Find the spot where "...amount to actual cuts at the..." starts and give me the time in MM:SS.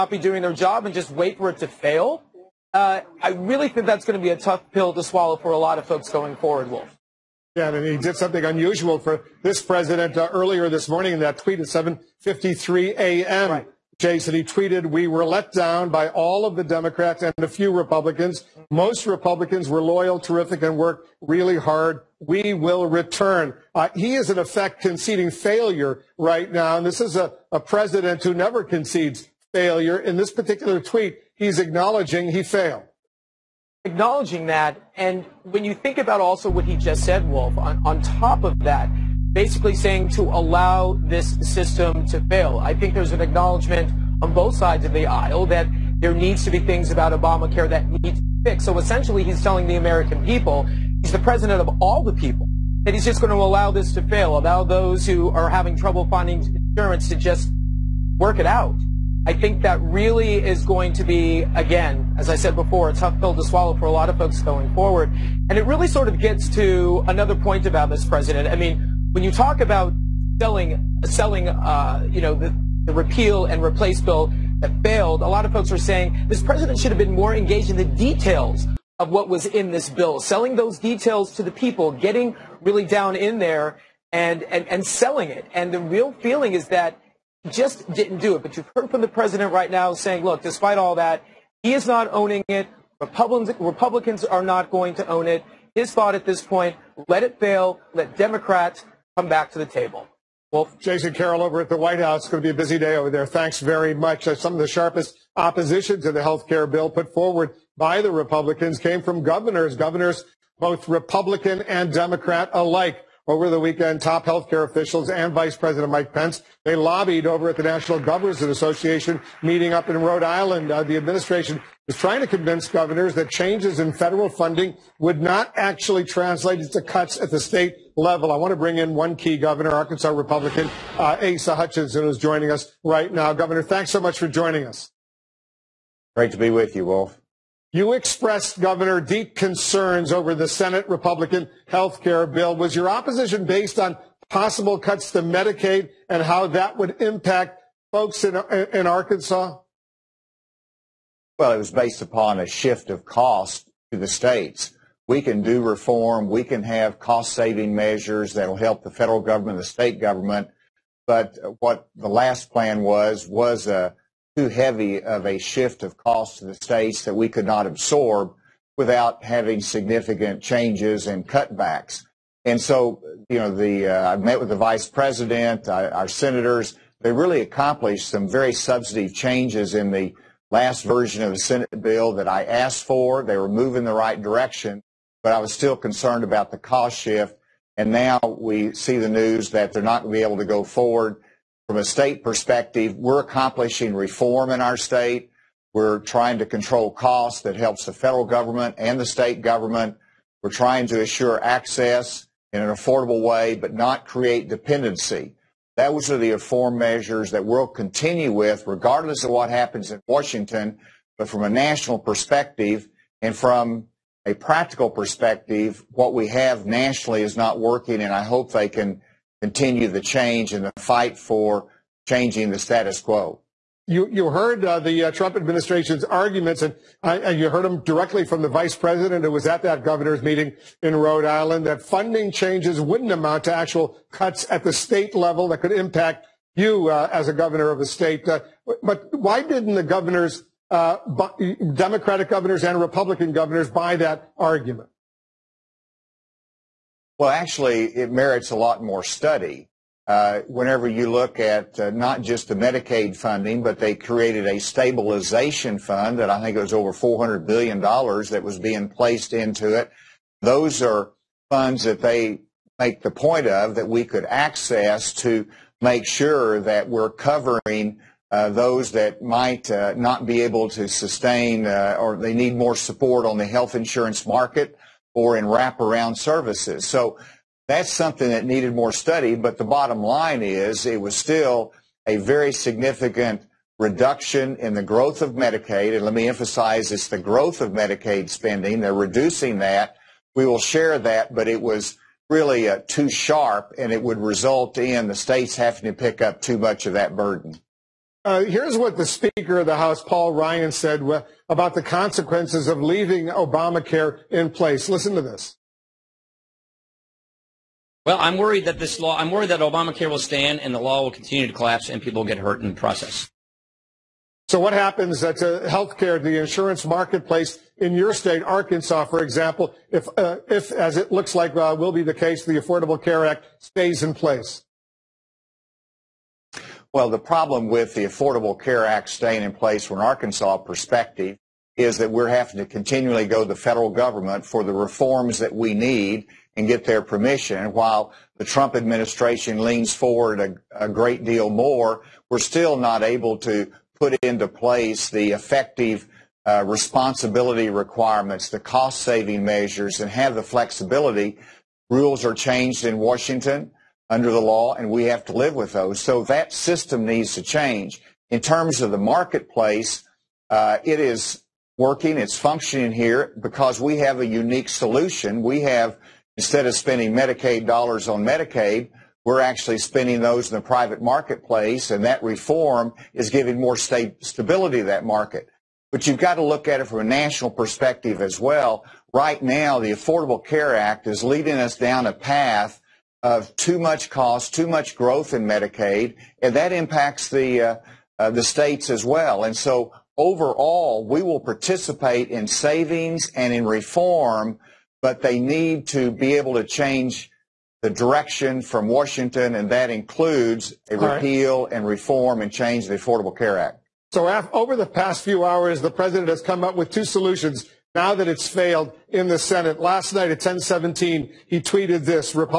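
03:53.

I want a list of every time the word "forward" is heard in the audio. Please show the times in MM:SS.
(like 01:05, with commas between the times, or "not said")
00:06, 01:04, 01:47, 03:10, 05:39.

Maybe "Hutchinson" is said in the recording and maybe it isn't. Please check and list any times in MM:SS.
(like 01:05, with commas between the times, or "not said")
02:11.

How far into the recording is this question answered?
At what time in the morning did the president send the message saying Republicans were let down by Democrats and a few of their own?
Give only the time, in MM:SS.
00:11.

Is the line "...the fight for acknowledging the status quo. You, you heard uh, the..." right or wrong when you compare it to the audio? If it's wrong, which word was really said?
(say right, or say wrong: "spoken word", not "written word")
wrong: "changing", not "acknowledging".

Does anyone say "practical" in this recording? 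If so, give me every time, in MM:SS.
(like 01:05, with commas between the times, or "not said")
03:34.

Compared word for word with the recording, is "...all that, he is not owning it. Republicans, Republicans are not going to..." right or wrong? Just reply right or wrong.
right.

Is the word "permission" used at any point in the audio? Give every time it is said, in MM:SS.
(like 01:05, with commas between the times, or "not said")
05:37.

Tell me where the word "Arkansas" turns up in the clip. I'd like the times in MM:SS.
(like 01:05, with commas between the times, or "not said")
02:09, 02:28, 05:18, 05:30.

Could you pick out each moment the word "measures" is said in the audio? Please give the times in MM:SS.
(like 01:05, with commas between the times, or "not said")
02:37, 03:26, 05:49.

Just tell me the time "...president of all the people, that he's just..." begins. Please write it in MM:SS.
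00:51.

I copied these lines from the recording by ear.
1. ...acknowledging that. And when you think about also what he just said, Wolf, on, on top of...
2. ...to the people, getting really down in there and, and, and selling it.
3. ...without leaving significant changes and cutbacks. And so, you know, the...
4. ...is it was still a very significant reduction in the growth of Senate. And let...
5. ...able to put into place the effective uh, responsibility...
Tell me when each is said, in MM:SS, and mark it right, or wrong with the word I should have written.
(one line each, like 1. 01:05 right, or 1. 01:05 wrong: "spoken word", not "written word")
1. 00:33 right
2. 01:21 right
3. 02:48 wrong: "having", not "leaving"
4. 04:40 wrong: "Medicaid", not "Senate"
5. 05:43 right.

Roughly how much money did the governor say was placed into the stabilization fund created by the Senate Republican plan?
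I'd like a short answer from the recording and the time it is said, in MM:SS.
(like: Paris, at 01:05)
Over $400 billion, at 04:16.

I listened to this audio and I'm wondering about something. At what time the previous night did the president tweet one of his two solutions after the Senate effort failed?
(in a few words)
10:17.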